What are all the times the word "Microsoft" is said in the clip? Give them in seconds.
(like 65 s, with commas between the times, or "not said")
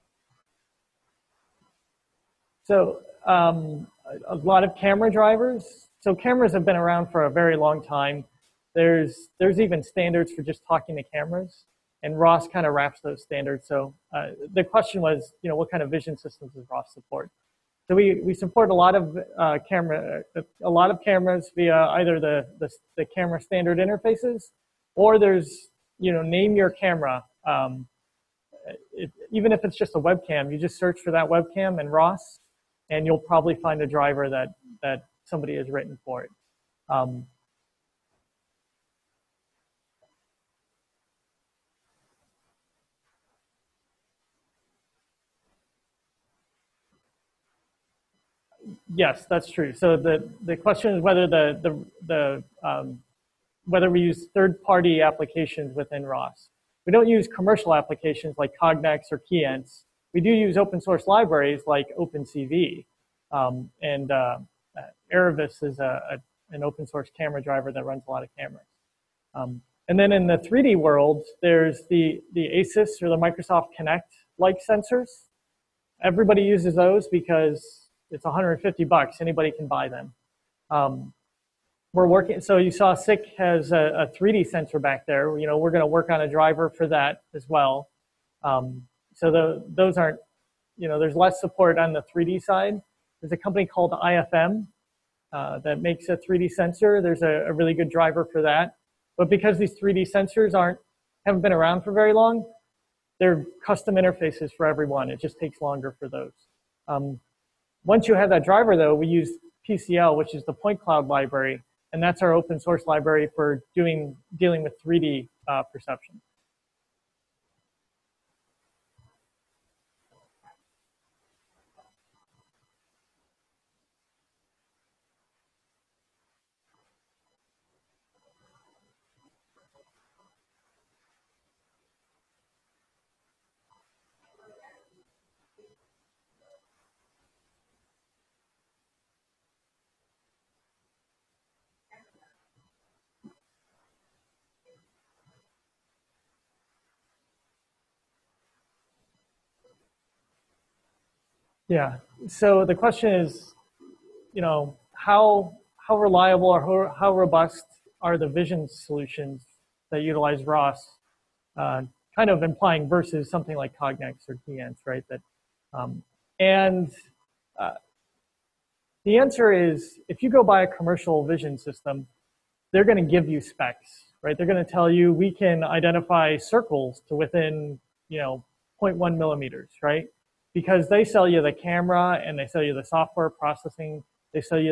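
73 s.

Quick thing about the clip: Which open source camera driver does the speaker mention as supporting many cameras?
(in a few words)
Aravis.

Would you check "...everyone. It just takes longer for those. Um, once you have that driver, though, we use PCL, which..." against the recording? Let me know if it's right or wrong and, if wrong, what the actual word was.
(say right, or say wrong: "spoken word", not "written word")
right.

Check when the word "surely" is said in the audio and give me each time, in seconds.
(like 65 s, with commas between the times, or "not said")
not said.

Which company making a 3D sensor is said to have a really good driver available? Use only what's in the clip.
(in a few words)
IFM.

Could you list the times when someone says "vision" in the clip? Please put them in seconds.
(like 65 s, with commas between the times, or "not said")
15 s, 158 s, 171 s.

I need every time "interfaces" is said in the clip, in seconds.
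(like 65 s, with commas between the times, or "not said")
23 s, 103 s.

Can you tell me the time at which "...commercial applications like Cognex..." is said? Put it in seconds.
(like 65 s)
57 s.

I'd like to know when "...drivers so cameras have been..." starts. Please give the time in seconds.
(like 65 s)
5 s.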